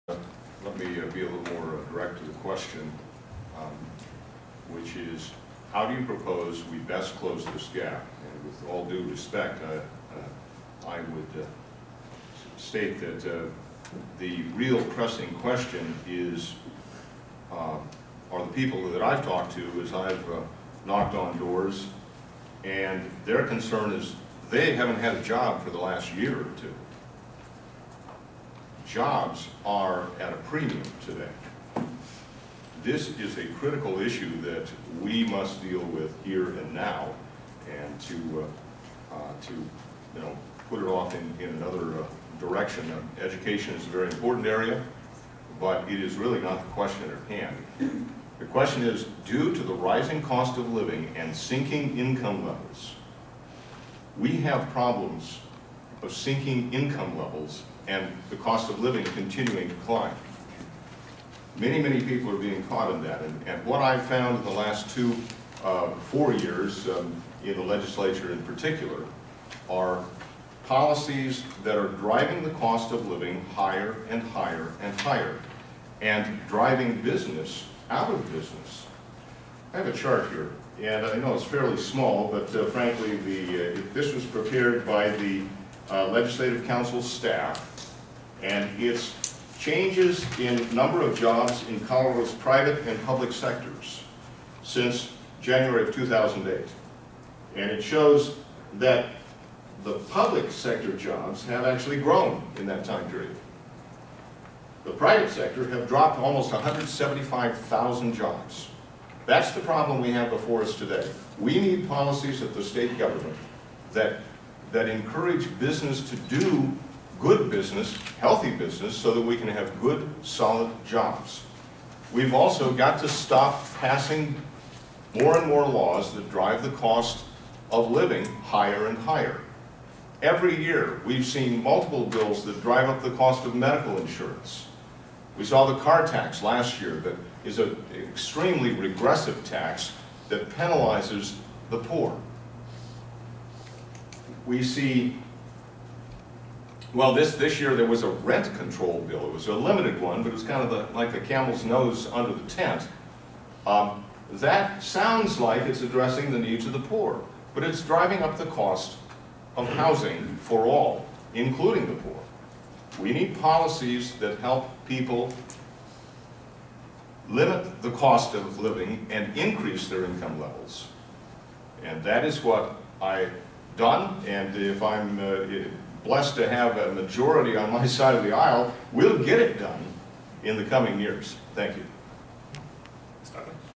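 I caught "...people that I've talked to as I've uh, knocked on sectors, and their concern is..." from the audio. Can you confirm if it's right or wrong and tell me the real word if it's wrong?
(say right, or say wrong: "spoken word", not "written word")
wrong: "doors", not "sectors".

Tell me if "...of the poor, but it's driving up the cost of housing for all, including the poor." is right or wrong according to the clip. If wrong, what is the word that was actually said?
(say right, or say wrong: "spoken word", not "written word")
right.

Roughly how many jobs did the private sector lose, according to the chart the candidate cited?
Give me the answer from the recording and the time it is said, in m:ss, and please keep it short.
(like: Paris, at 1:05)
175,000, at 1:46.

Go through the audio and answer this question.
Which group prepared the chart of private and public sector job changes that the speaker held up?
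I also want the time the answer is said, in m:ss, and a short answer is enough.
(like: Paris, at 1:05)
Legislative Council staff, at 1:26.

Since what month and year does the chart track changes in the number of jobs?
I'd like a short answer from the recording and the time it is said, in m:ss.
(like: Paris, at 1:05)
January 2008, at 1:35.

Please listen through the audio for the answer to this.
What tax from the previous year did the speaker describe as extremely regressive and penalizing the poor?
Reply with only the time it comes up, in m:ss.
2:15.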